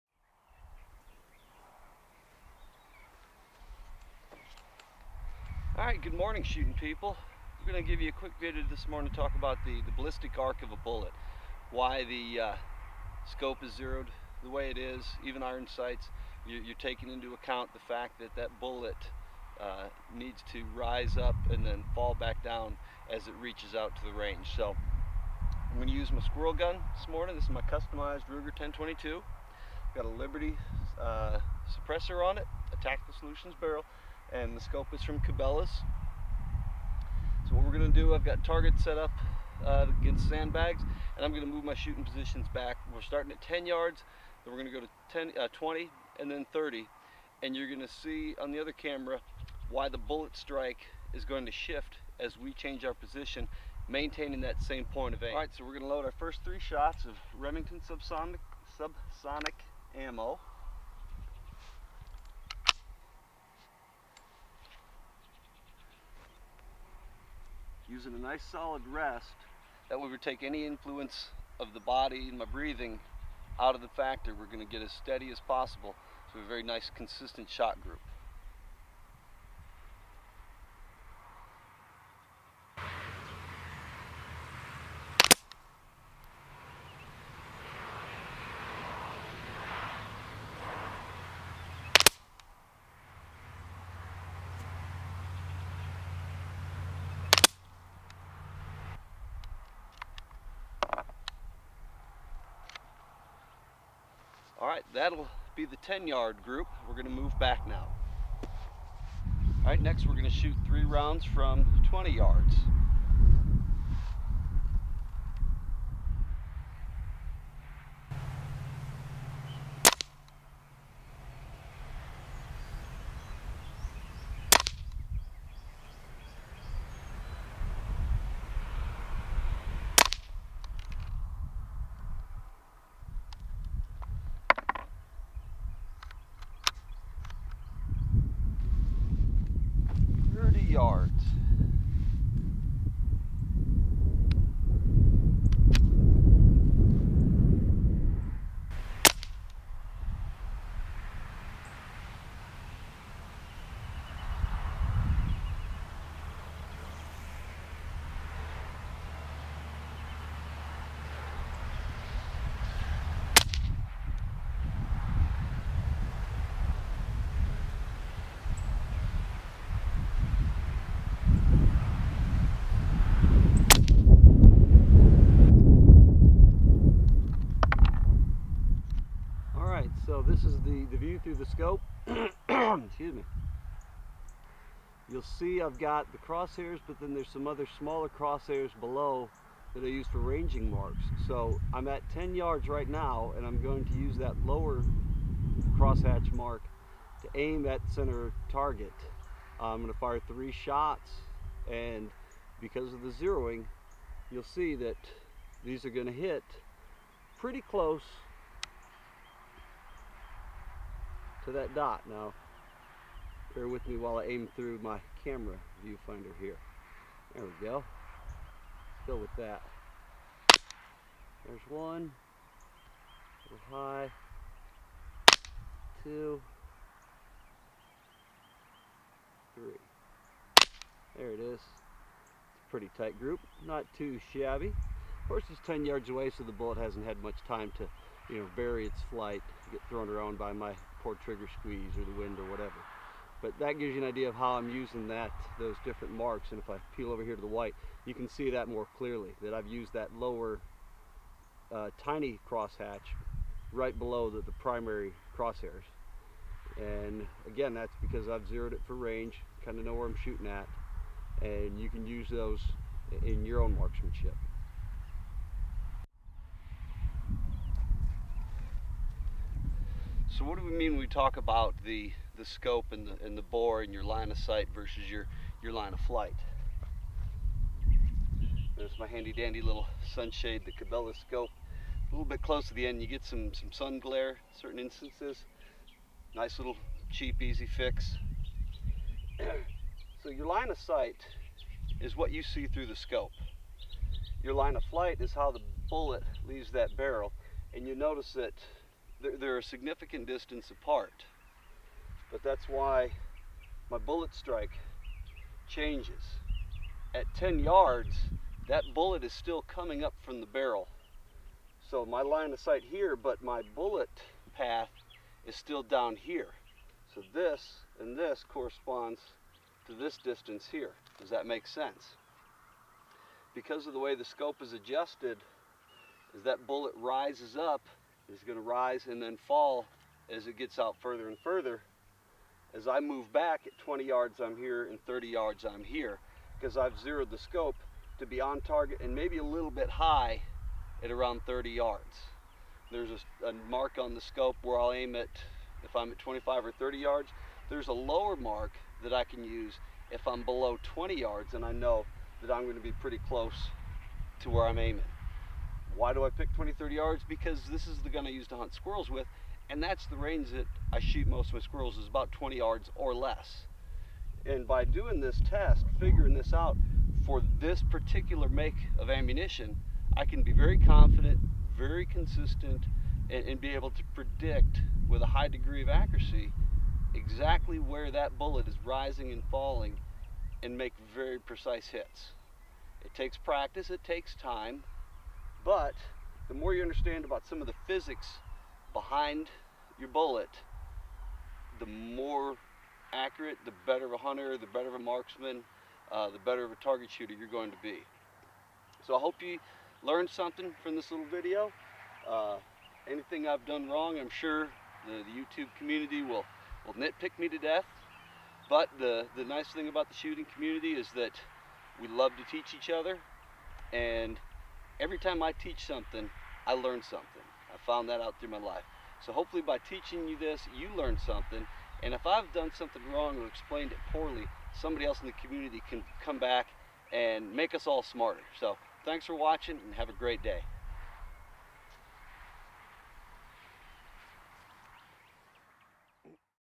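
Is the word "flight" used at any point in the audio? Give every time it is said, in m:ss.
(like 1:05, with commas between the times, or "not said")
3:59, 4:35, 4:54.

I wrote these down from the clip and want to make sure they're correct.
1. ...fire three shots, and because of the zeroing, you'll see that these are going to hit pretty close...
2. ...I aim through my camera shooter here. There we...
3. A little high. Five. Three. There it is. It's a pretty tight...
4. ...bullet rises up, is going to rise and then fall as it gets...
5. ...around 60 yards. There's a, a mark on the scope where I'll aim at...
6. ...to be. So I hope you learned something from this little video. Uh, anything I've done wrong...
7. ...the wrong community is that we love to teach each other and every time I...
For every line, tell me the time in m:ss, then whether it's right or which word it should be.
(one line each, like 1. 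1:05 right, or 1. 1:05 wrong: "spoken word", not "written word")
1. 3:19 right
2. 3:34 wrong: "viewfinder", not "shooter"
3. 3:43 wrong: "Two", not "Five"
4. 5:26 right
5. 5:41 wrong: "30", not "60"
6. 6:37 right
7. 6:50 wrong: "shooting", not "wrong".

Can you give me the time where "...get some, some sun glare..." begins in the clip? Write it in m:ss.
4:43.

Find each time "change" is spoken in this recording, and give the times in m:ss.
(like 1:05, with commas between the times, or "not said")
0:52, 5:05.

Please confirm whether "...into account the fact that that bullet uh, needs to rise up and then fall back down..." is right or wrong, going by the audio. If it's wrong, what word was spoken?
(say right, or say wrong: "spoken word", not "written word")
right.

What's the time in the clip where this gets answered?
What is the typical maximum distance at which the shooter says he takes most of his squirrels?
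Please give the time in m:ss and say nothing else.
6:02.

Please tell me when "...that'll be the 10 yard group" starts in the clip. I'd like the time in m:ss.
1:44.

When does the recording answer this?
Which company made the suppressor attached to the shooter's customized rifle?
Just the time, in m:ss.
0:30.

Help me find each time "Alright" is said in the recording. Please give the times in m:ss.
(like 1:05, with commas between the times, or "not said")
0:05, 0:55.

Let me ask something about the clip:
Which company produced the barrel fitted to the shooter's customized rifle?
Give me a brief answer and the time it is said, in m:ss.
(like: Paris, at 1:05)
Tactical Solutions, at 0:32.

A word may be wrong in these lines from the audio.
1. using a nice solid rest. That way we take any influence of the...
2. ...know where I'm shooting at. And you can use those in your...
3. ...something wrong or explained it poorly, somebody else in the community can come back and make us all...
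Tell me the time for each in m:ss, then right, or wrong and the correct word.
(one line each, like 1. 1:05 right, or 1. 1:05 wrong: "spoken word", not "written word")
1. 1:07 right
2. 4:19 right
3. 7:02 right.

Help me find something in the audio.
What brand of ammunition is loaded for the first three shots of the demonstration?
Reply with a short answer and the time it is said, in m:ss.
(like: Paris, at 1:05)
Remington, at 0:57.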